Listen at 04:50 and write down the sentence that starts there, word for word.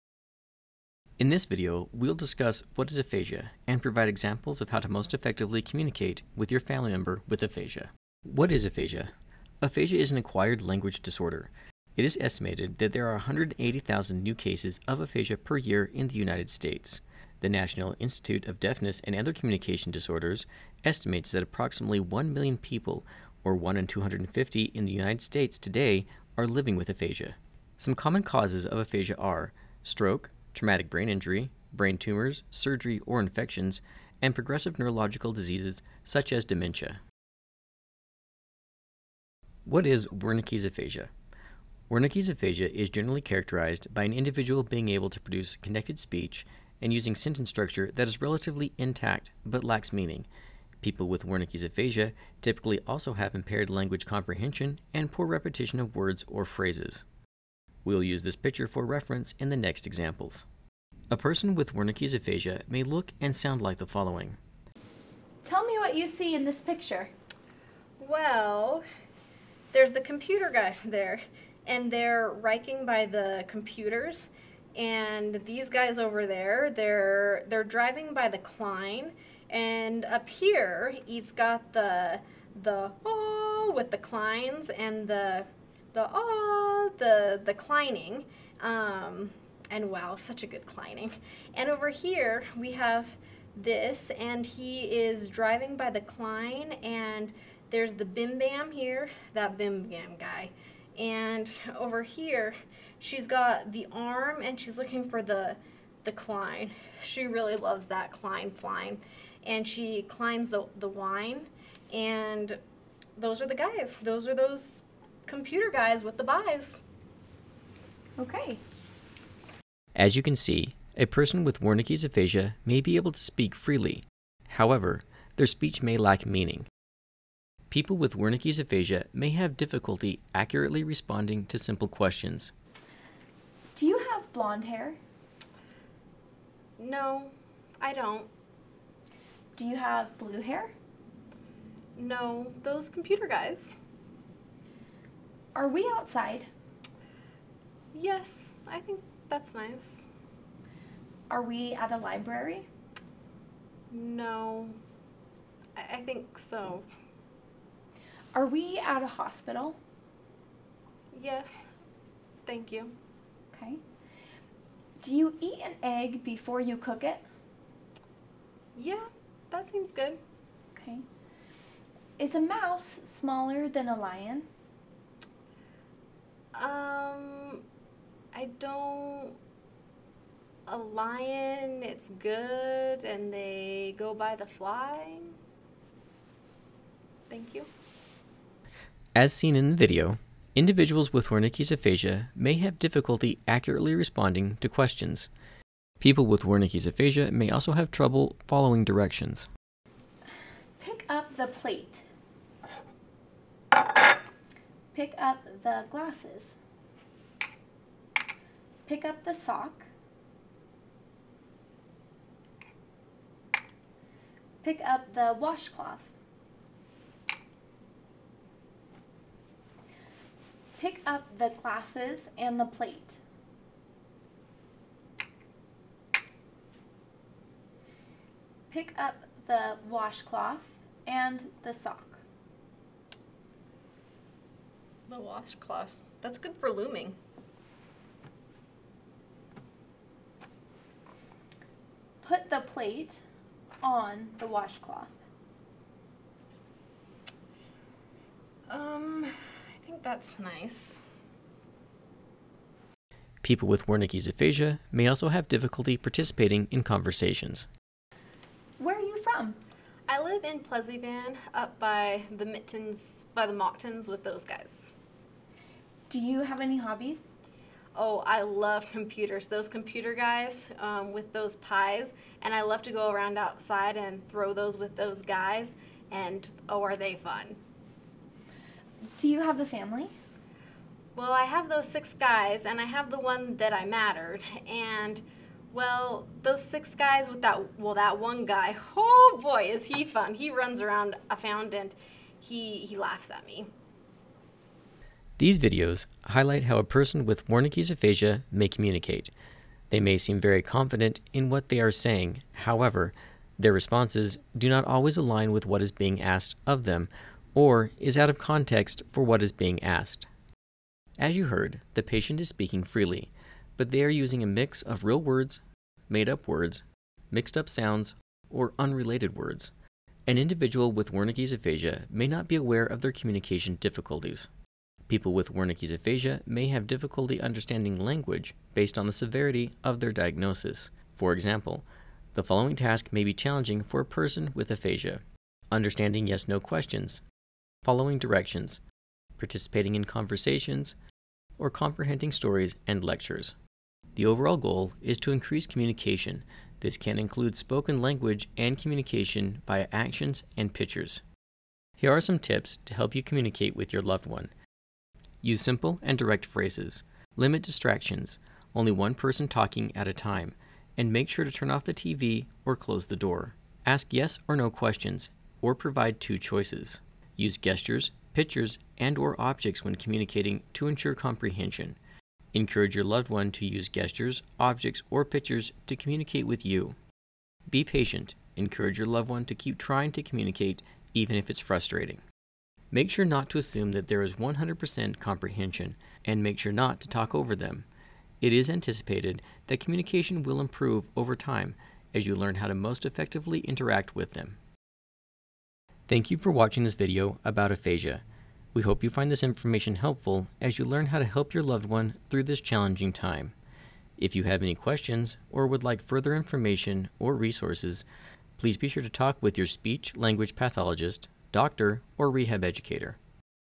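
He runs around, I found, and he, he laughs at me.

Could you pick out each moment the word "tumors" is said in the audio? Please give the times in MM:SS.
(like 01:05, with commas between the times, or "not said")
00:31.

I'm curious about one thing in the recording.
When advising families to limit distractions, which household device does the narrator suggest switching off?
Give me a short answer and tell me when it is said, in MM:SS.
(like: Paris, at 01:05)
TV, at 06:01.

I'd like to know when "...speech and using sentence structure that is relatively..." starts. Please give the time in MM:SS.
00:45.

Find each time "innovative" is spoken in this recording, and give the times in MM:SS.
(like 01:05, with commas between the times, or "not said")
not said.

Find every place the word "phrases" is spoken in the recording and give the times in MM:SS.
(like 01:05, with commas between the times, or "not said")
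00:56, 05:56.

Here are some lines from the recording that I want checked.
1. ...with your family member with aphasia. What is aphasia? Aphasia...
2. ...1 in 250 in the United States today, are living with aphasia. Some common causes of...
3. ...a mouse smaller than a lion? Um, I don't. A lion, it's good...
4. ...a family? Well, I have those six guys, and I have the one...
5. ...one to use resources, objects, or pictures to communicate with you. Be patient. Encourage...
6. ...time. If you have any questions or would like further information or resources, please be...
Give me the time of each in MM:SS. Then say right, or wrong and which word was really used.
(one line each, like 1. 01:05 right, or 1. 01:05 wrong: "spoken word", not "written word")
1. 00:06 right
2. 00:23 right
3. 02:52 right
4. 04:39 right
5. 06:13 wrong: "gestures", not "resources"
6. 06:43 right.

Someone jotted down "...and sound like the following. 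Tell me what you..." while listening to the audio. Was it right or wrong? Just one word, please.
right.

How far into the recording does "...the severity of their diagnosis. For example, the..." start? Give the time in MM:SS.
05:29.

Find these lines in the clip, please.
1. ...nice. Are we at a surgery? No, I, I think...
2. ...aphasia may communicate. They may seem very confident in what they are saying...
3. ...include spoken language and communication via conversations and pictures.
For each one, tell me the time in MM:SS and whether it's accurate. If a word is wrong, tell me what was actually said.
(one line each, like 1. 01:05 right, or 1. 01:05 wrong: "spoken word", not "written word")
1. 02:29 wrong: "library", not "surgery"
2. 04:57 right
3. 05:47 wrong: "actions", not "conversations".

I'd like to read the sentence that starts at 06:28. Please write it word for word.
It is anticipated that communication will improve over time as you learn how to most effectively interact with them.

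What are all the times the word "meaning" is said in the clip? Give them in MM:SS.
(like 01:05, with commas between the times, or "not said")
00:49, 02:06.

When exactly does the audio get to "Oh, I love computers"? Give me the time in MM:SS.
04:27.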